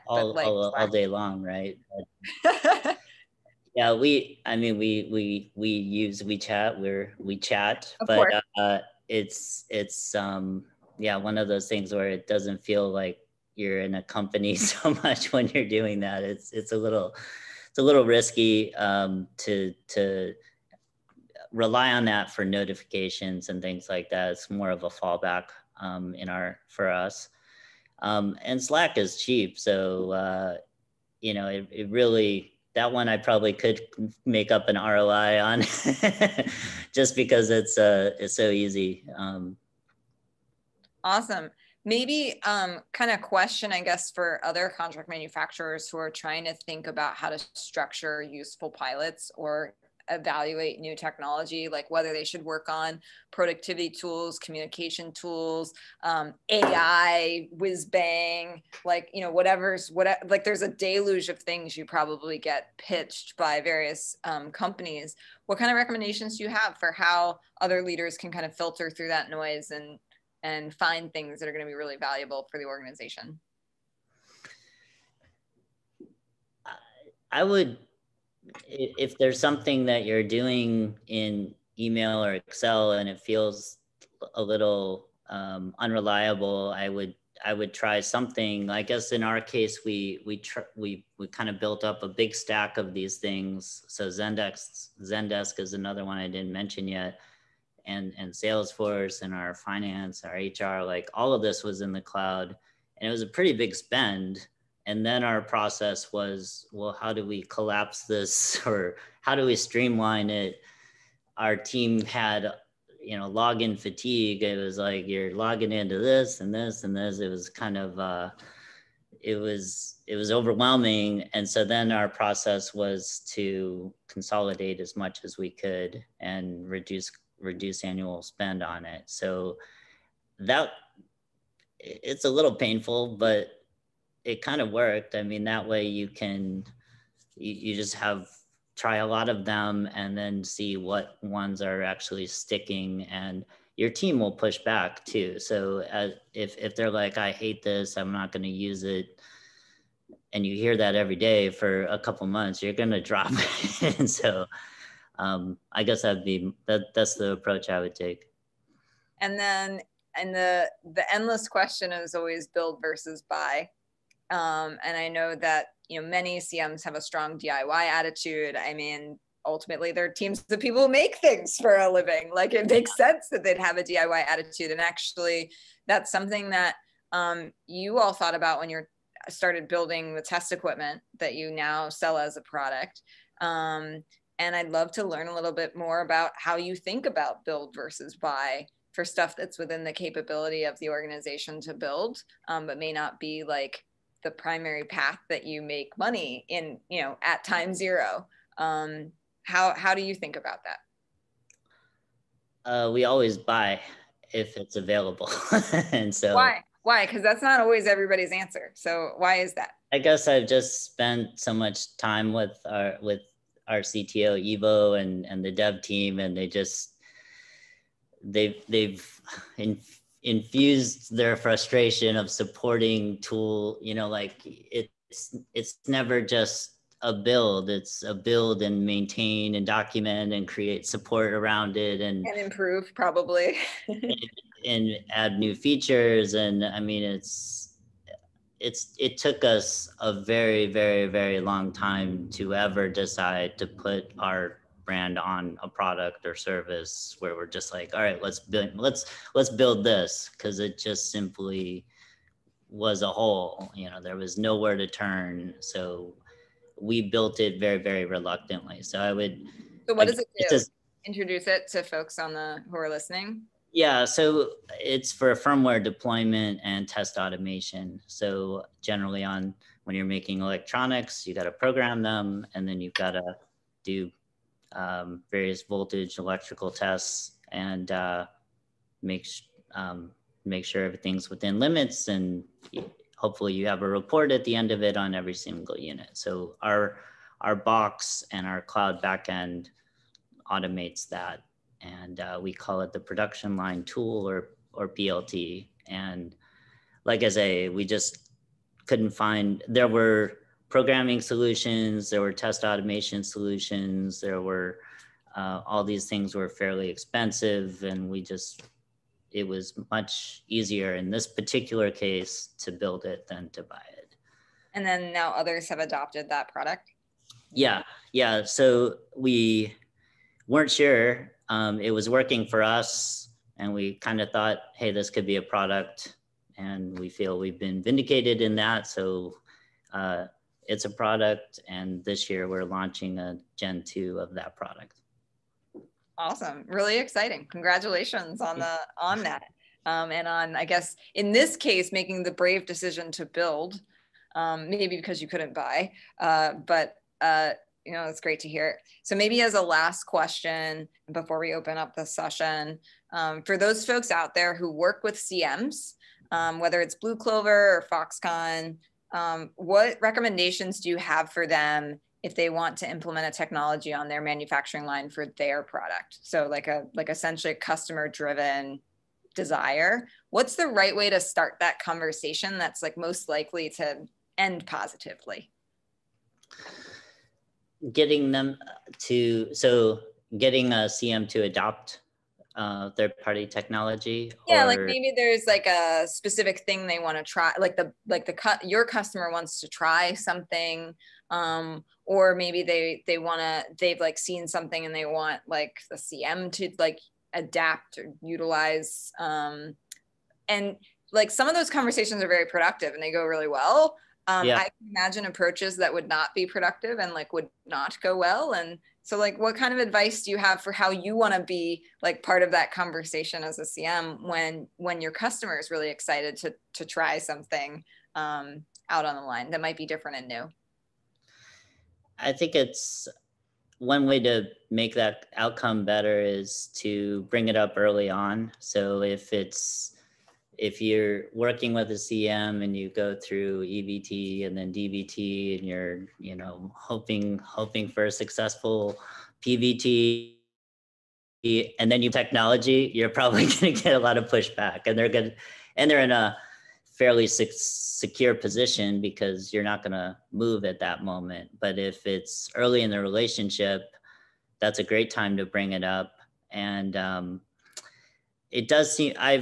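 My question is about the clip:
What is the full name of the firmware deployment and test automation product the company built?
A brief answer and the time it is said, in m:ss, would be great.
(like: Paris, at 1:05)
Production line tool, at 4:52.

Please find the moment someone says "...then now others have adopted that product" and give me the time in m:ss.
5:14.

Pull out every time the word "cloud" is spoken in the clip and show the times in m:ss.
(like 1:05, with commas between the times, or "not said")
1:42, 4:48.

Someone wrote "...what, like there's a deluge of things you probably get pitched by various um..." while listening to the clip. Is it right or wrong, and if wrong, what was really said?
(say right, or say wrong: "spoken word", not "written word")
right.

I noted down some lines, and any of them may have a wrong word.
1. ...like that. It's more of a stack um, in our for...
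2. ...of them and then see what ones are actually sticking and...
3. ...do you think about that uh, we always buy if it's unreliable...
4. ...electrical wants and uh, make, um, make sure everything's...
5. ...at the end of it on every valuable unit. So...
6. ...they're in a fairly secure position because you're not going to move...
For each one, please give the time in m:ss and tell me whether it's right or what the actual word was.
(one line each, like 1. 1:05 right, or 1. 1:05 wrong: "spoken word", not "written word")
1. 0:23 wrong: "fallback", not "stack"
2. 2:19 right
3. 3:19 wrong: "available", not "unreliable"
4. 4:36 wrong: "tests", not "wants"
5. 4:44 wrong: "single", not "valuable"
6. 7:25 right.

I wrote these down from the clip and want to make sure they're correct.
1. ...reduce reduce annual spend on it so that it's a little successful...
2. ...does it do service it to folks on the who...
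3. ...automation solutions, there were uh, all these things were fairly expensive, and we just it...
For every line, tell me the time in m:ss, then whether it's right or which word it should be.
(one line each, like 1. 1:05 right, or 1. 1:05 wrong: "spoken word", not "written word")
1. 2:06 wrong: "painful", not "successful"
2. 4:20 wrong: "introduce", not "service"
3. 5:02 right.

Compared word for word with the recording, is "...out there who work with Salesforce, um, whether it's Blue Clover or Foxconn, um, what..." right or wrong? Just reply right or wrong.
wrong.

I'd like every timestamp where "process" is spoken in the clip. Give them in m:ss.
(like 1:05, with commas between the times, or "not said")
1:45, 2:02.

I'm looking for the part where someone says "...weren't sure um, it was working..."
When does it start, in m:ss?
5:20.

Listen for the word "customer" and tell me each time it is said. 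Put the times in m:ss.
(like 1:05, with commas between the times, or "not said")
6:07, 6:28, 6:55.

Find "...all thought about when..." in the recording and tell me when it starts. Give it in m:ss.
2:57.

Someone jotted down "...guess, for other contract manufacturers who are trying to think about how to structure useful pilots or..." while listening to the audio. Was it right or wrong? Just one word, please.
right.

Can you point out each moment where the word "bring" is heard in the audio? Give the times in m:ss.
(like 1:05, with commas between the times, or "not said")
7:07, 7:35.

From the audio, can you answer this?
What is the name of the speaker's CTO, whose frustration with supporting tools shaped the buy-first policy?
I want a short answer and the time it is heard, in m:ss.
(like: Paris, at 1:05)
Evo, at 3:34.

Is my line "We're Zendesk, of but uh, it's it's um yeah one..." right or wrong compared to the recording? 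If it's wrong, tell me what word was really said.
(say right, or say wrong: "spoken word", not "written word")
wrong: "WeChat", not "Zendesk".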